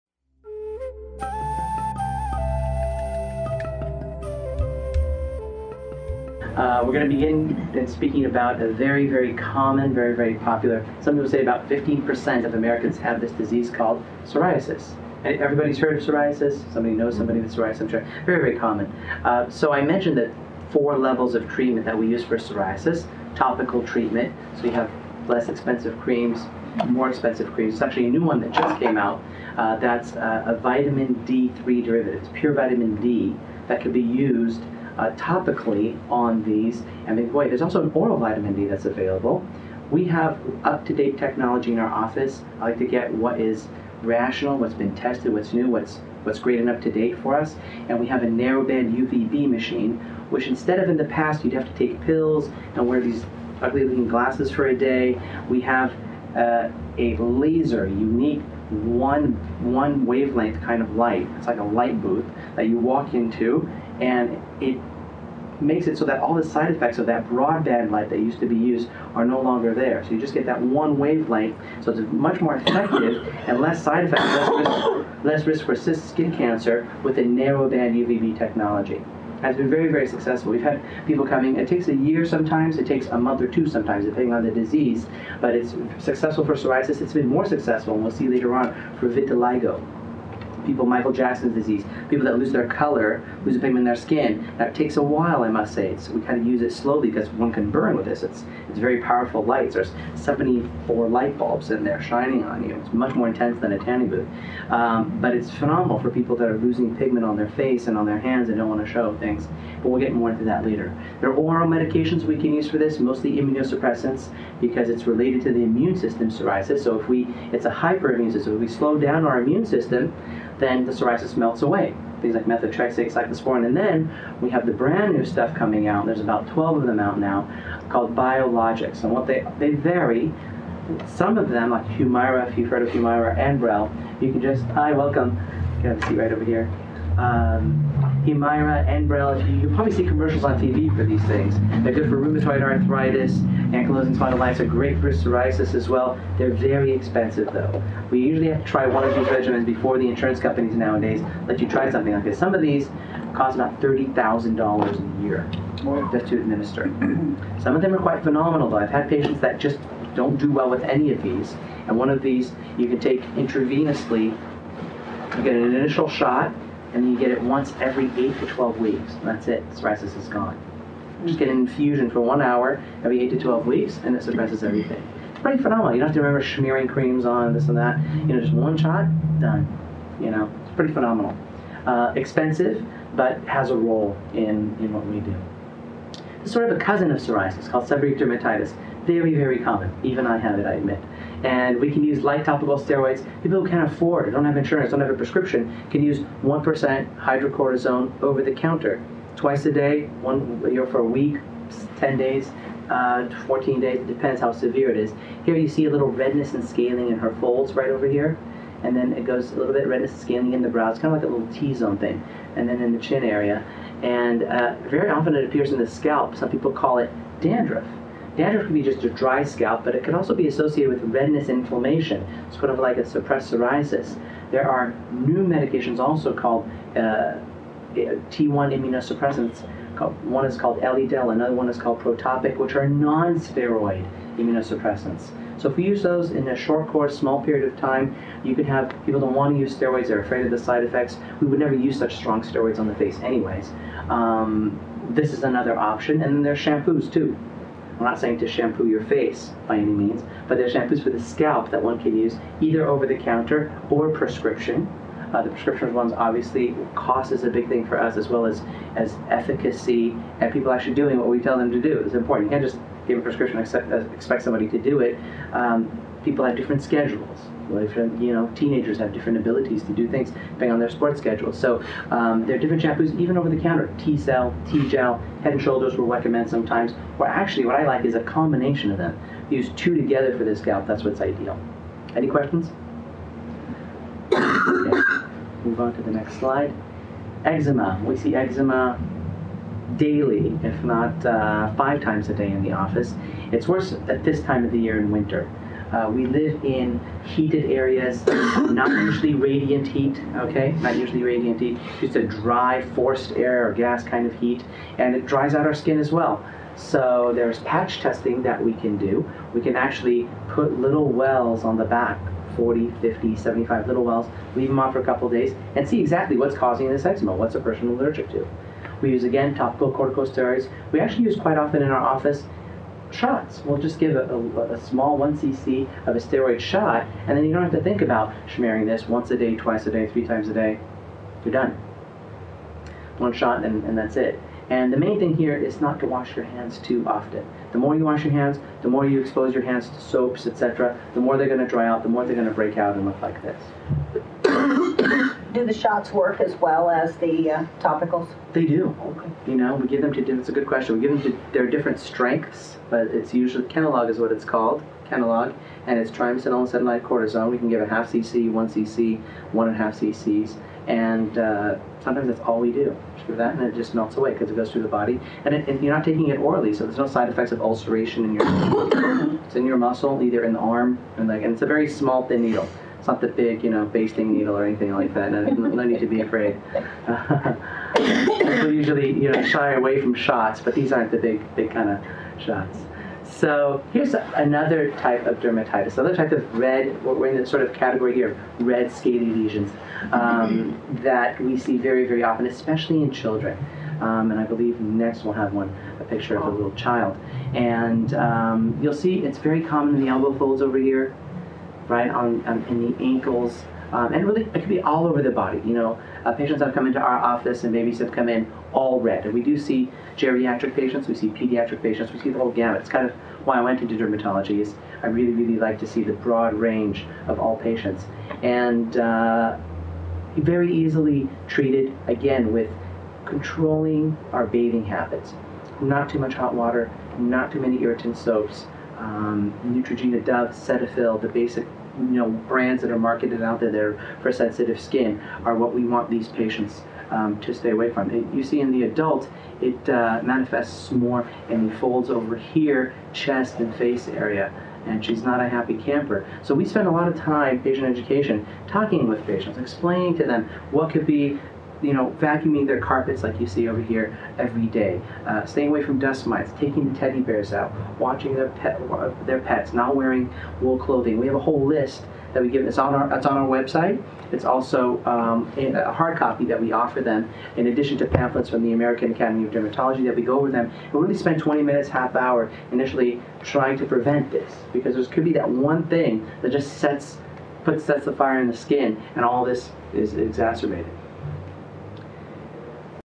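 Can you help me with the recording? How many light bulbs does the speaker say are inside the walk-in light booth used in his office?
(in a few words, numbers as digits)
74.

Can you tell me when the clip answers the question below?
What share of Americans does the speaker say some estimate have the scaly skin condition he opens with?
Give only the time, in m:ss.
0:11.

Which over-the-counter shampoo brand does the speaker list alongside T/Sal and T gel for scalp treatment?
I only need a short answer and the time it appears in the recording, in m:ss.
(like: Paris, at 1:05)
Head and Shoulders, at 4:35.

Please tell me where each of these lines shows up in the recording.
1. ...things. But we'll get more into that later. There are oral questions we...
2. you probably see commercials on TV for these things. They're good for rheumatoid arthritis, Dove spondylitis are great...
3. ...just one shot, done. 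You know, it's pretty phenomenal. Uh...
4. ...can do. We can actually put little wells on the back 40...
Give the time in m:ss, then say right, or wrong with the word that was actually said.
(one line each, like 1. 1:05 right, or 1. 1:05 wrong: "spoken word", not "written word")
1. 1:49 wrong: "medications", not "questions"
2. 2:19 wrong: "Ankylosing", not "Dove"
3. 2:58 right
4. 5:08 right.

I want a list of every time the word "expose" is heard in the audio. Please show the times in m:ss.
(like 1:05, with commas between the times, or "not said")
5:39.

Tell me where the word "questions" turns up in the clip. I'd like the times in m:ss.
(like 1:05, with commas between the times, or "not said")
4:42, 5:50.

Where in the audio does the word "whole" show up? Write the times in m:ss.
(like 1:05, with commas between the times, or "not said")
6:52, 7:41.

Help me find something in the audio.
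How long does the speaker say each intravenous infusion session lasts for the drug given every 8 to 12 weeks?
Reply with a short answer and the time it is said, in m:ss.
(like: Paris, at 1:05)
One hour, at 2:52.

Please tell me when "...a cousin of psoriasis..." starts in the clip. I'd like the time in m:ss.
3:06.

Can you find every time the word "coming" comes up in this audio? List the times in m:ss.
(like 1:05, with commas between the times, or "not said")
1:21, 2:05.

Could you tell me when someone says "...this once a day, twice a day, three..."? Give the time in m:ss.
5:28.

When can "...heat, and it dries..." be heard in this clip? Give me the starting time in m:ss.
5:04.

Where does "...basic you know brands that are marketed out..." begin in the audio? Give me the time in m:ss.
7:11.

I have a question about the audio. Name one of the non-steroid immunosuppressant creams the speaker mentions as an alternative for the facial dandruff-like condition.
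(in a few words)
Elidel.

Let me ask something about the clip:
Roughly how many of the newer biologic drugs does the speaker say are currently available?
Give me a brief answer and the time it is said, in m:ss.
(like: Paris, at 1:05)
About 12, at 2:06.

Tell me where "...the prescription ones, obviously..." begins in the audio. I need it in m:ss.
4:15.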